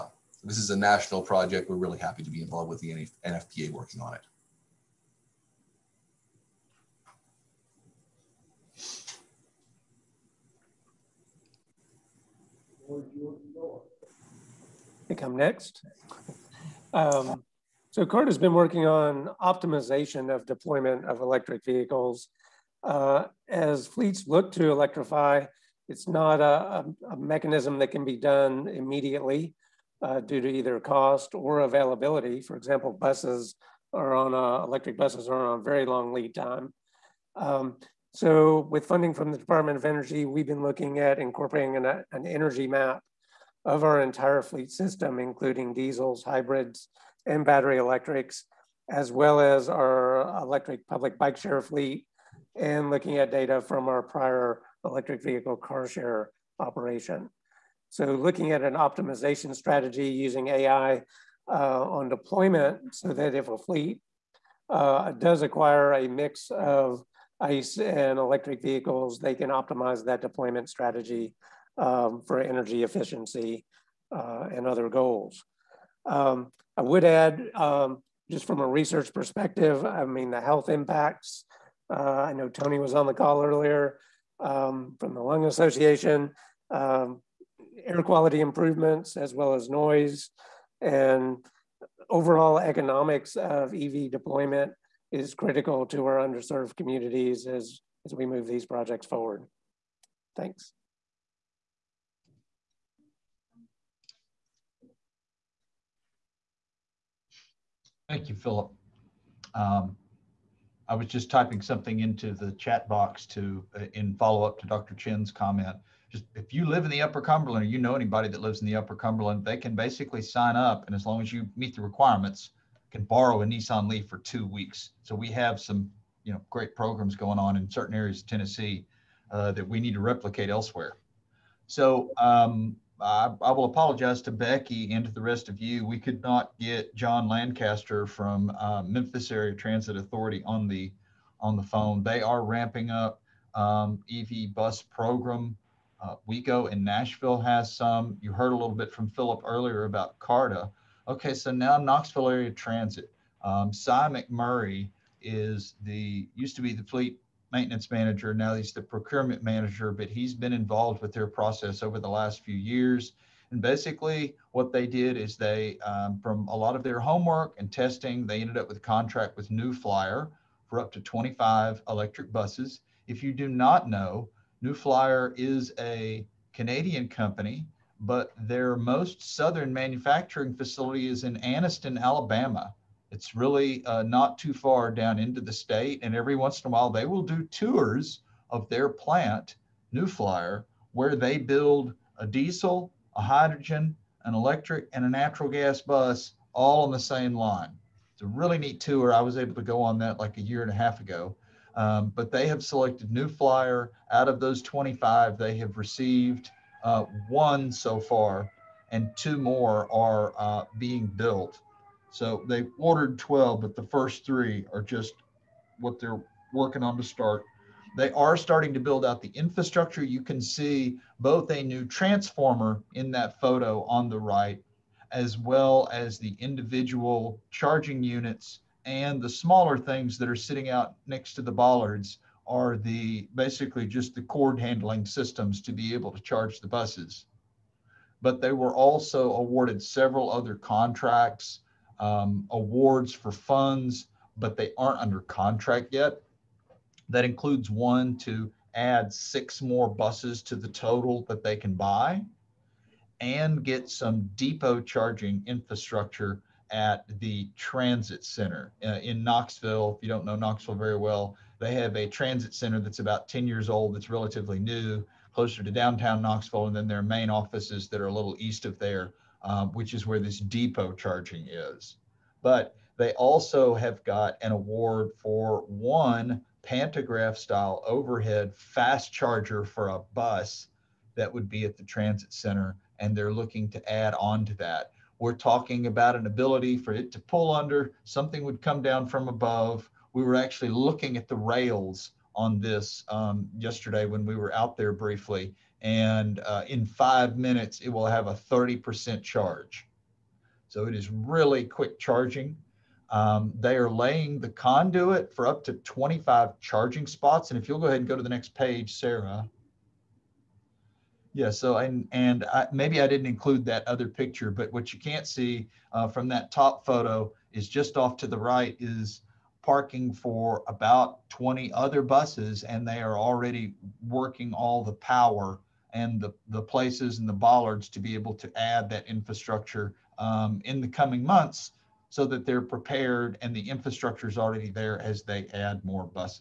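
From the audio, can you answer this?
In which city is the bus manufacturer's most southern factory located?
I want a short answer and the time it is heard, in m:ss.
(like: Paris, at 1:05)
Anniston, Alabama, at 3:01.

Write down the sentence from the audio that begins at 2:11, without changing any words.
So um, I, I, will apologize to Becky and to the rest of you.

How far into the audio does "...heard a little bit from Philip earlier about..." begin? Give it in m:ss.
2:28.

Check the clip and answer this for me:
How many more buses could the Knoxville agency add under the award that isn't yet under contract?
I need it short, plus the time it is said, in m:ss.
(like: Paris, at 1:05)
6, at 4:09.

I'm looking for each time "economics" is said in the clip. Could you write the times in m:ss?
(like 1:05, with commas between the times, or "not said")
1:32.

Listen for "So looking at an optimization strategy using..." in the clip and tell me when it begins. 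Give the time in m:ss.
0:57.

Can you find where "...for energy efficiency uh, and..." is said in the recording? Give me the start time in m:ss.
1:12.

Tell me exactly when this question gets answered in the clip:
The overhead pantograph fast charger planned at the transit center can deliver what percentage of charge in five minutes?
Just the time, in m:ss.
4:58.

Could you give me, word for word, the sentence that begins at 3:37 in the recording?
They are starting to build out the infrastructure.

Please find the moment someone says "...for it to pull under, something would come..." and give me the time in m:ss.
4:46.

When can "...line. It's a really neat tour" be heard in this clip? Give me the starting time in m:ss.
3:17.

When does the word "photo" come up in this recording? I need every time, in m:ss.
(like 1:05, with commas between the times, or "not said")
3:43, 5:16.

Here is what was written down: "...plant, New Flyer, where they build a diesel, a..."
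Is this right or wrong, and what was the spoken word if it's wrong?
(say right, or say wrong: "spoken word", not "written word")
right.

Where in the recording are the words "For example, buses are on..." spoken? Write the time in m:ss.
0:32.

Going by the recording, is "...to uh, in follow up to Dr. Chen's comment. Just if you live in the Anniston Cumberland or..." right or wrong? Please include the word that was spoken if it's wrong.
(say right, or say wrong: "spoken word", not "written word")
wrong: "Upper", not "Anniston".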